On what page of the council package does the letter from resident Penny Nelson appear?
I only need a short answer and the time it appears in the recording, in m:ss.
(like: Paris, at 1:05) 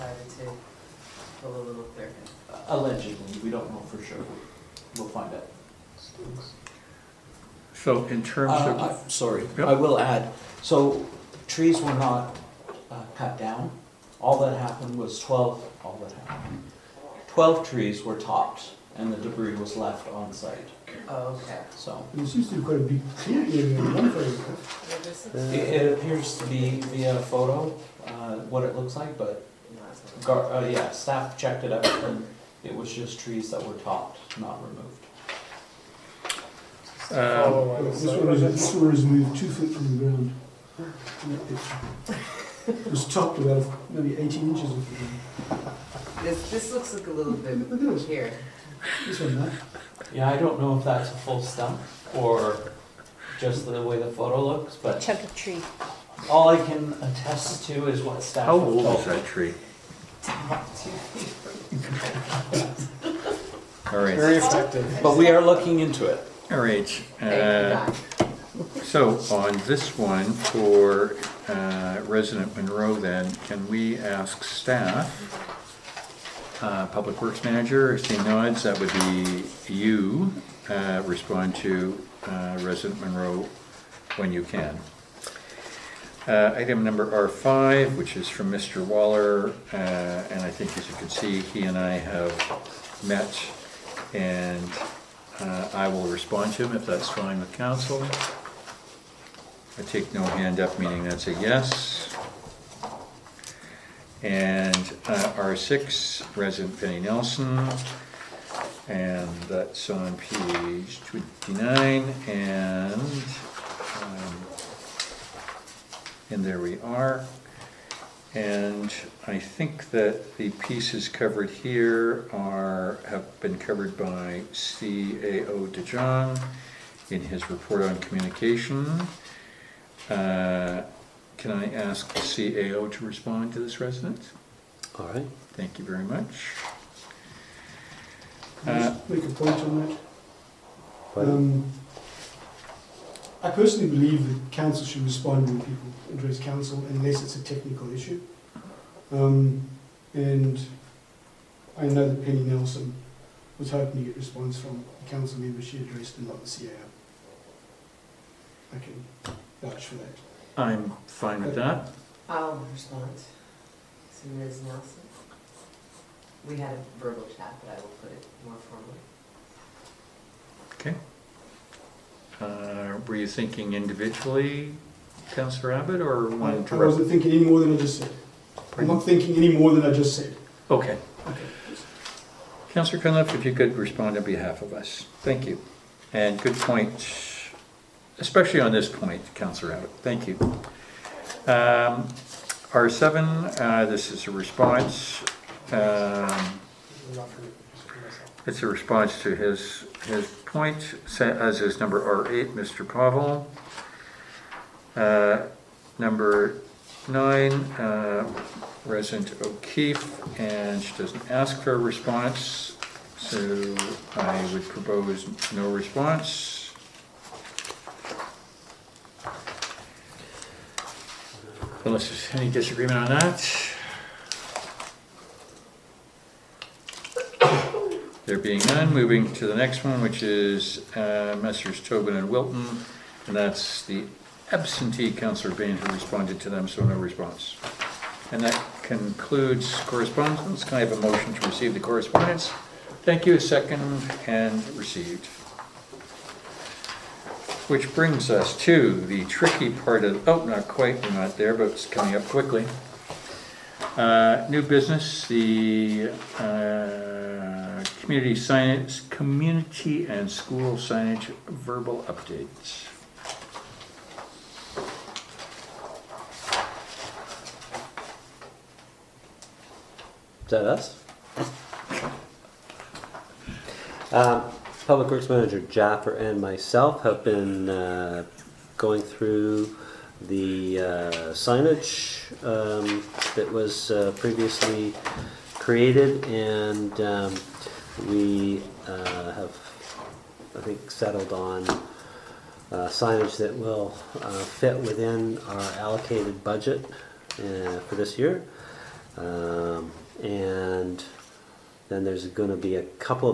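29, at 1:50.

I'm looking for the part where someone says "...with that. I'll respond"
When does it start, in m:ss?
2:41.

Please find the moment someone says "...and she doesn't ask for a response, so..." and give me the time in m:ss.
3:30.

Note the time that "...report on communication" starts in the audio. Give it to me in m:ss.
2:07.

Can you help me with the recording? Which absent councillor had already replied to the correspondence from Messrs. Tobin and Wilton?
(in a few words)
Bain.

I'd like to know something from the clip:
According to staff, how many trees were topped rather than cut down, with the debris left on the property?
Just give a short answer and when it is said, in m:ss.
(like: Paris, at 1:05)
12, at 0:17.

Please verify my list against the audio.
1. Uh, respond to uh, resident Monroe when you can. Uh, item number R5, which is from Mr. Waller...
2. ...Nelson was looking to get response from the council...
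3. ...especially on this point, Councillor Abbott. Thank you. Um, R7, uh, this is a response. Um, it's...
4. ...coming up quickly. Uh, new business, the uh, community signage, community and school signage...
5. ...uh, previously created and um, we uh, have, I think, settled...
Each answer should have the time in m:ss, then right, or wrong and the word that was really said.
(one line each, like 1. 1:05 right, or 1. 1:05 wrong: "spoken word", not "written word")
1. 1:20 right
2. 2:32 wrong: "hoping", not "looking"
3. 3:08 right
4. 4:11 right
5. 4:43 right.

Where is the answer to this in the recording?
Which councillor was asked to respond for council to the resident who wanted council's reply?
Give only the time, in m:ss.
3:02.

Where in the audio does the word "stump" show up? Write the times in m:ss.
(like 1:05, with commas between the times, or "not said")
0:51.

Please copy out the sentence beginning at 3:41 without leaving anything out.
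Unless there's any disagreement on that.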